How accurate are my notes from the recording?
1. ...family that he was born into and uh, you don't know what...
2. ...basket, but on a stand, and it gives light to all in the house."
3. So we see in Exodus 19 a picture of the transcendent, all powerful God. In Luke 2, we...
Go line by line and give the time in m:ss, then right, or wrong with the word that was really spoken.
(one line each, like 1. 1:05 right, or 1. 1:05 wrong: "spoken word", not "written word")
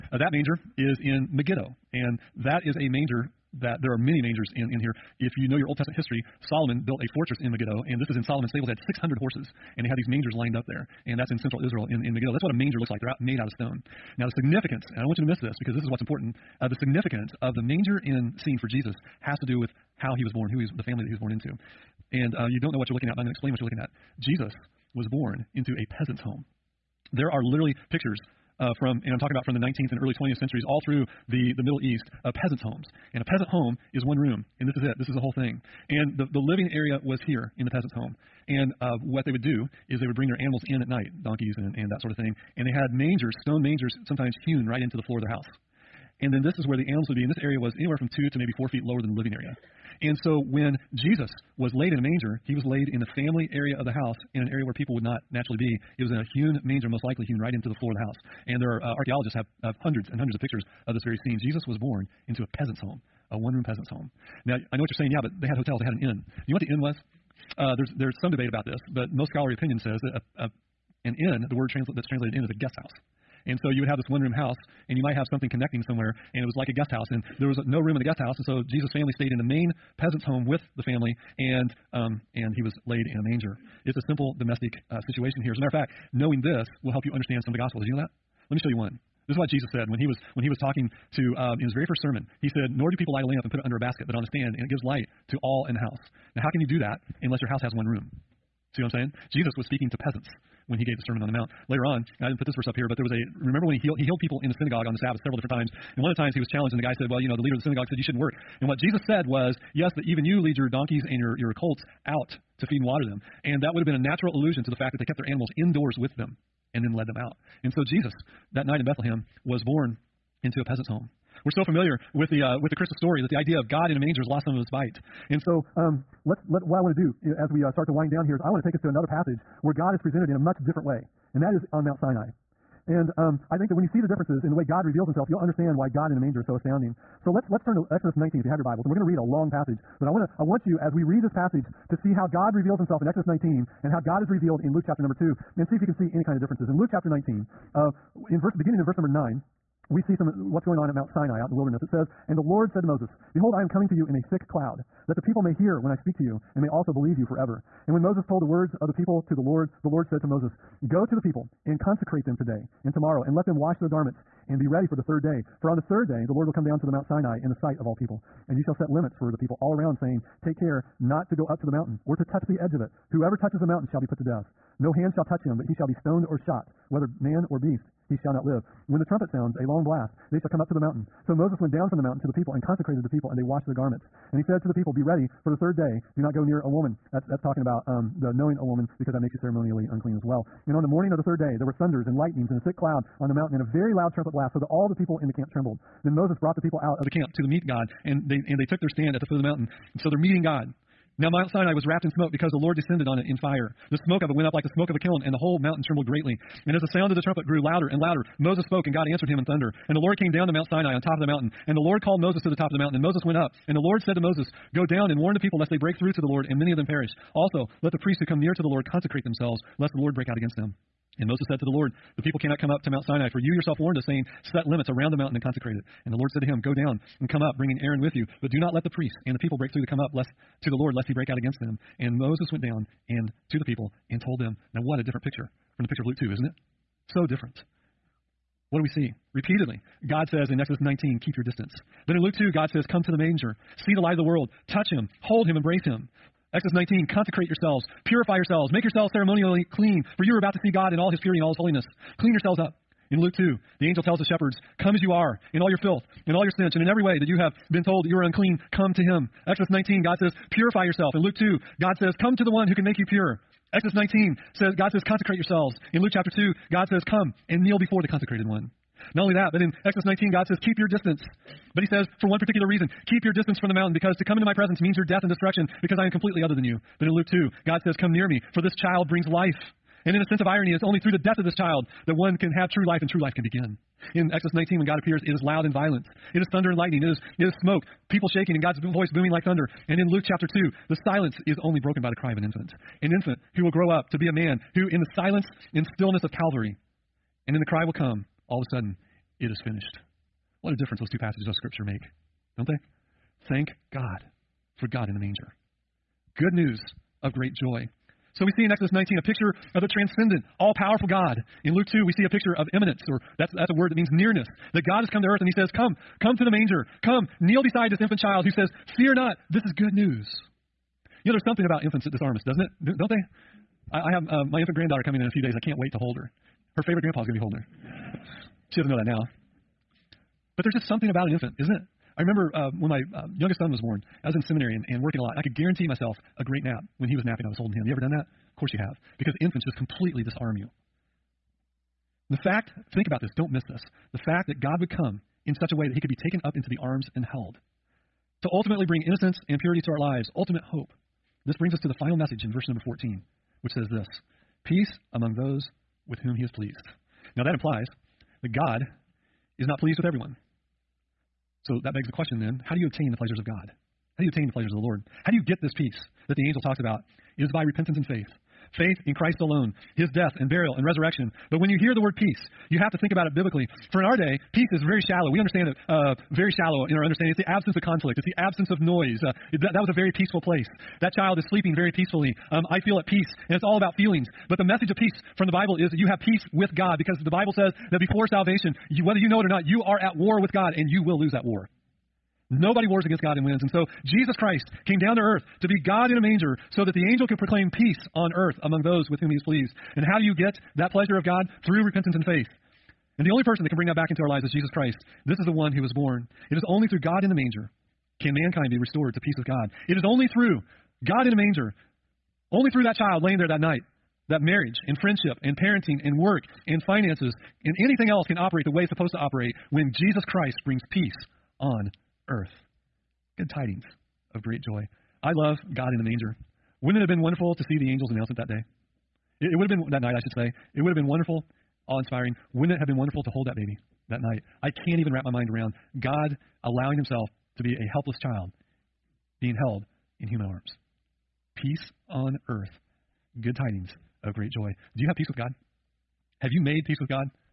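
1. 0:20 right
2. 1:33 right
3. 5:08 right.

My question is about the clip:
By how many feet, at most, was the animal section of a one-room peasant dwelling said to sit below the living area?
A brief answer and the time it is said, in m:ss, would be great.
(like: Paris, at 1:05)
4, at 0:48.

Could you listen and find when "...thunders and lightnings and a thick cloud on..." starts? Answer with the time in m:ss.
3:11.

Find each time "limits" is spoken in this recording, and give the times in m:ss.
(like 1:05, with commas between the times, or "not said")
2:48, 3:44.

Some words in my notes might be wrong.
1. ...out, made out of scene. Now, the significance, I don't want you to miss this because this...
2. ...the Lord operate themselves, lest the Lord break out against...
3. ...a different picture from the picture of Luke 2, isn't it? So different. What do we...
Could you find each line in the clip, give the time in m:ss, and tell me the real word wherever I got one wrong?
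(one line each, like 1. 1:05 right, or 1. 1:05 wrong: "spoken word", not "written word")
1. 0:13 wrong: "stone", not "scene"
2. 3:38 wrong: "consecrate", not "operate"
3. 3:54 right.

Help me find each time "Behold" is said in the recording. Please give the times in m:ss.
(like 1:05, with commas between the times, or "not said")
2:33.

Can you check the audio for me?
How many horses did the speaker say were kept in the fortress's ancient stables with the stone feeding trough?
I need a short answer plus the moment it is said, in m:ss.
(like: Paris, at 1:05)
600, at 0:08.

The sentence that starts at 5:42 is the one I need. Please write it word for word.
And the fact, think about this, don't miss this.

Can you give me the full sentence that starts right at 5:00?
What a difference those two passages of Scripture make, don't they?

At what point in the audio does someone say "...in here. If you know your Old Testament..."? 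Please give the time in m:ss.
0:04.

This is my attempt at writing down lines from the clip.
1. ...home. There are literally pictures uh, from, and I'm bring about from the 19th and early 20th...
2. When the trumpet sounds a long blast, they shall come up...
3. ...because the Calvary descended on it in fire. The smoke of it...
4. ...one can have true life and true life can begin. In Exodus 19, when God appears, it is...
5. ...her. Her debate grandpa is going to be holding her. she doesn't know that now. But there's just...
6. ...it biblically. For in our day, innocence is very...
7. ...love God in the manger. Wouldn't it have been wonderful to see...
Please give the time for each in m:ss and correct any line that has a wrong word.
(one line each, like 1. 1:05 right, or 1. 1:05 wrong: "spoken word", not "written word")
1. 0:26 wrong: "talking", not "bring"
2. 2:58 right
3. 3:22 wrong: "Lord", not "Calvary"
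4. 4:42 right
5. 5:26 wrong: "favorite", not "debate"
6. 6:13 wrong: "peace", not "innocence"
7. 7:05 right.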